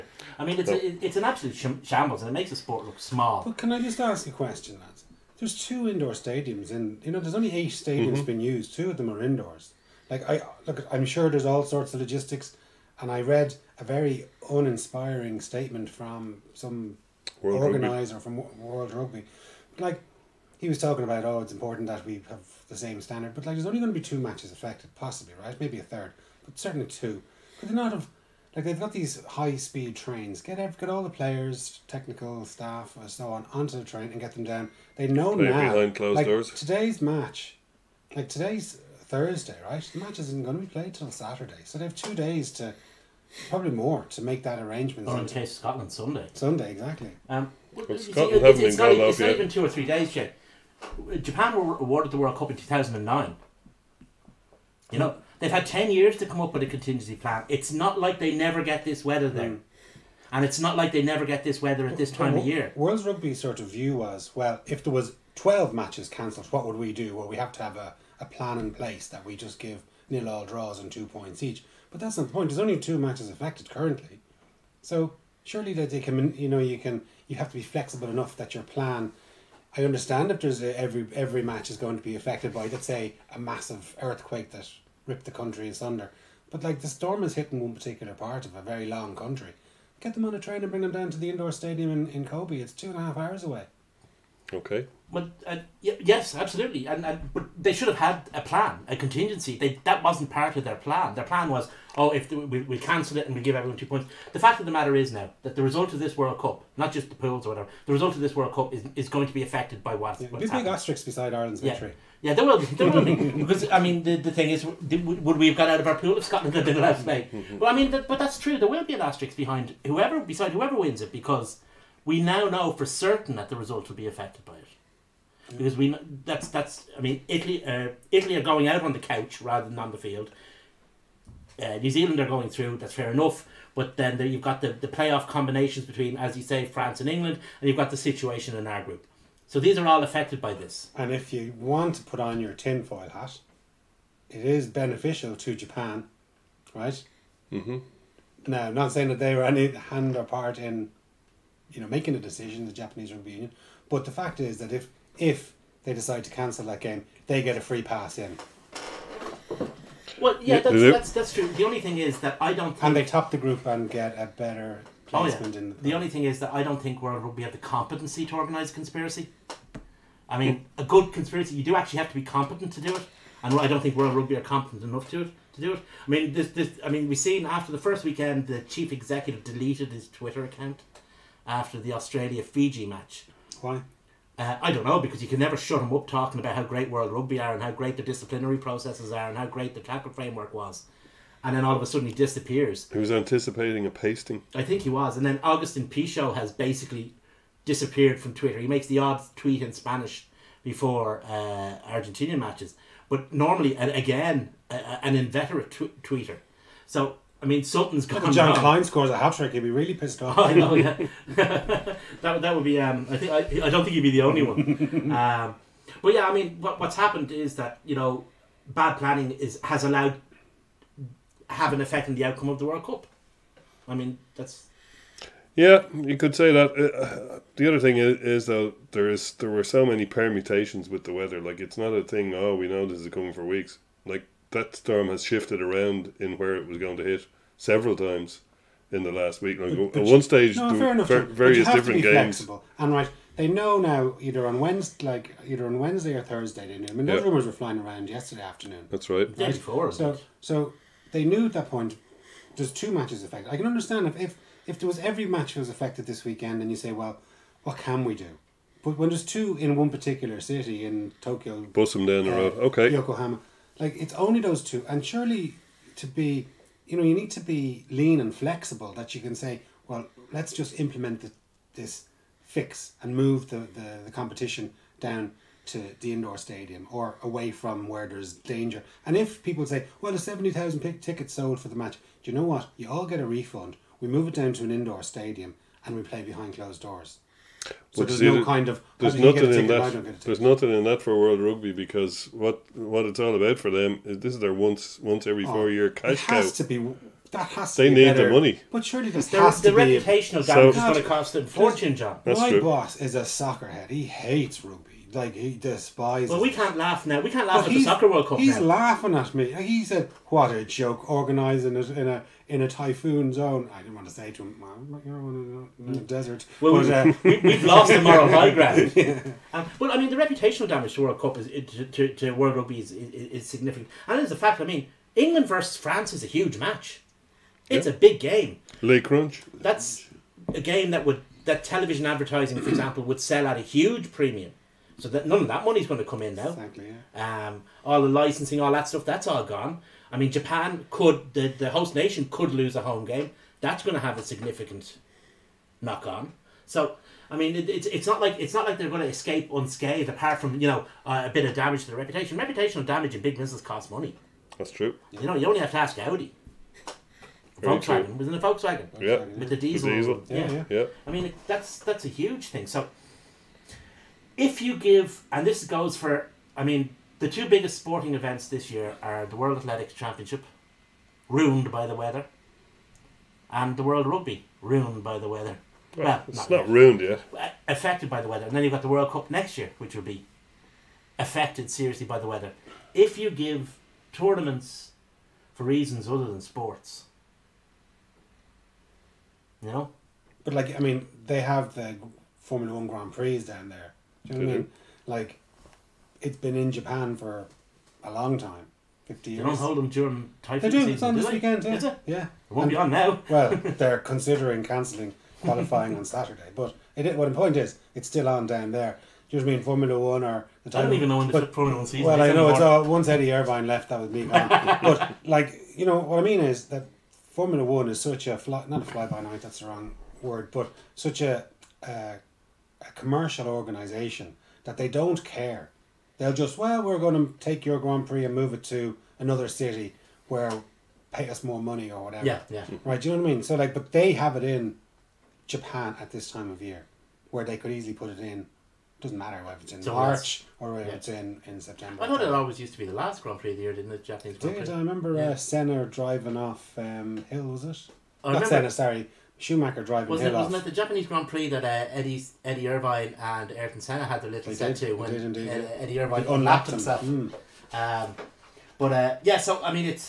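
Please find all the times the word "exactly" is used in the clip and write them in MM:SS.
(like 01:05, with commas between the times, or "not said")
00:46, 05:36.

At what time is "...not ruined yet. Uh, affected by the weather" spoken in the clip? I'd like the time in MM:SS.
06:16.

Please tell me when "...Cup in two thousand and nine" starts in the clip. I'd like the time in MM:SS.
00:52.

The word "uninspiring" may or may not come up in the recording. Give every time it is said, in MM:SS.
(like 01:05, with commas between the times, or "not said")
00:14.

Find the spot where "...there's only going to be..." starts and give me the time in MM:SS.
00:23.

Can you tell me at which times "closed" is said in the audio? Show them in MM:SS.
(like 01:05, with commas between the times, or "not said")
00:35, 04:46.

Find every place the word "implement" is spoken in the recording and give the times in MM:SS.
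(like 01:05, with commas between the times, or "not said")
04:30.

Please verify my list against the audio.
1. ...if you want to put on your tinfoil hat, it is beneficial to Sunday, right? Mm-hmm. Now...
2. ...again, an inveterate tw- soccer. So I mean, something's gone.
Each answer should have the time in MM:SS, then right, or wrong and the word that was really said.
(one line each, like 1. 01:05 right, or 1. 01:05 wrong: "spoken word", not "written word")
1. 02:21 wrong: "Japan", not "Sunday"
2. 03:23 wrong: "tweeter", not "soccer".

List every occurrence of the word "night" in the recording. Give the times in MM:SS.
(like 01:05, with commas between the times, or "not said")
01:57, 06:59.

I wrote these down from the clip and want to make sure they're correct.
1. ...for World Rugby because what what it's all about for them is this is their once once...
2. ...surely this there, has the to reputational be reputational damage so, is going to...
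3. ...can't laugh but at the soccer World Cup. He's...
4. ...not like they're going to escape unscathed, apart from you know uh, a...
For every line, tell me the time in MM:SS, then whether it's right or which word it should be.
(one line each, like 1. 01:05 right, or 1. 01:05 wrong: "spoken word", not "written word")
1. 04:51 right
2. 04:58 right
3. 05:07 right
4. 05:48 right.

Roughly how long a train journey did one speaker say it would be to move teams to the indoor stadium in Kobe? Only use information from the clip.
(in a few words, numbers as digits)
two and a half hours.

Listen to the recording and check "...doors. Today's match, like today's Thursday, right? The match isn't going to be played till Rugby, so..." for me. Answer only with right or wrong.
wrong.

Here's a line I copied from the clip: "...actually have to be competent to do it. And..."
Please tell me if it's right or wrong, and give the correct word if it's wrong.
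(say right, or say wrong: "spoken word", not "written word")
right.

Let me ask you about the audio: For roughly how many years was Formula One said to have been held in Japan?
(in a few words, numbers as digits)
50 years.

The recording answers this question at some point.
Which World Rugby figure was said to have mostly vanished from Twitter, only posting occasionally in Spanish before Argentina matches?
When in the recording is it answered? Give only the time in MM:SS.
03:15.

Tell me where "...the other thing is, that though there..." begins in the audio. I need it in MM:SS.
03:47.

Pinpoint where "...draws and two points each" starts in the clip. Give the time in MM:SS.
01:10.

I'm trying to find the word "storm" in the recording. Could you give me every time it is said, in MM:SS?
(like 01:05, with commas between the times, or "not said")
01:26, 03:54.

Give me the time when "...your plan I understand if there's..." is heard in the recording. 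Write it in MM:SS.
01:18.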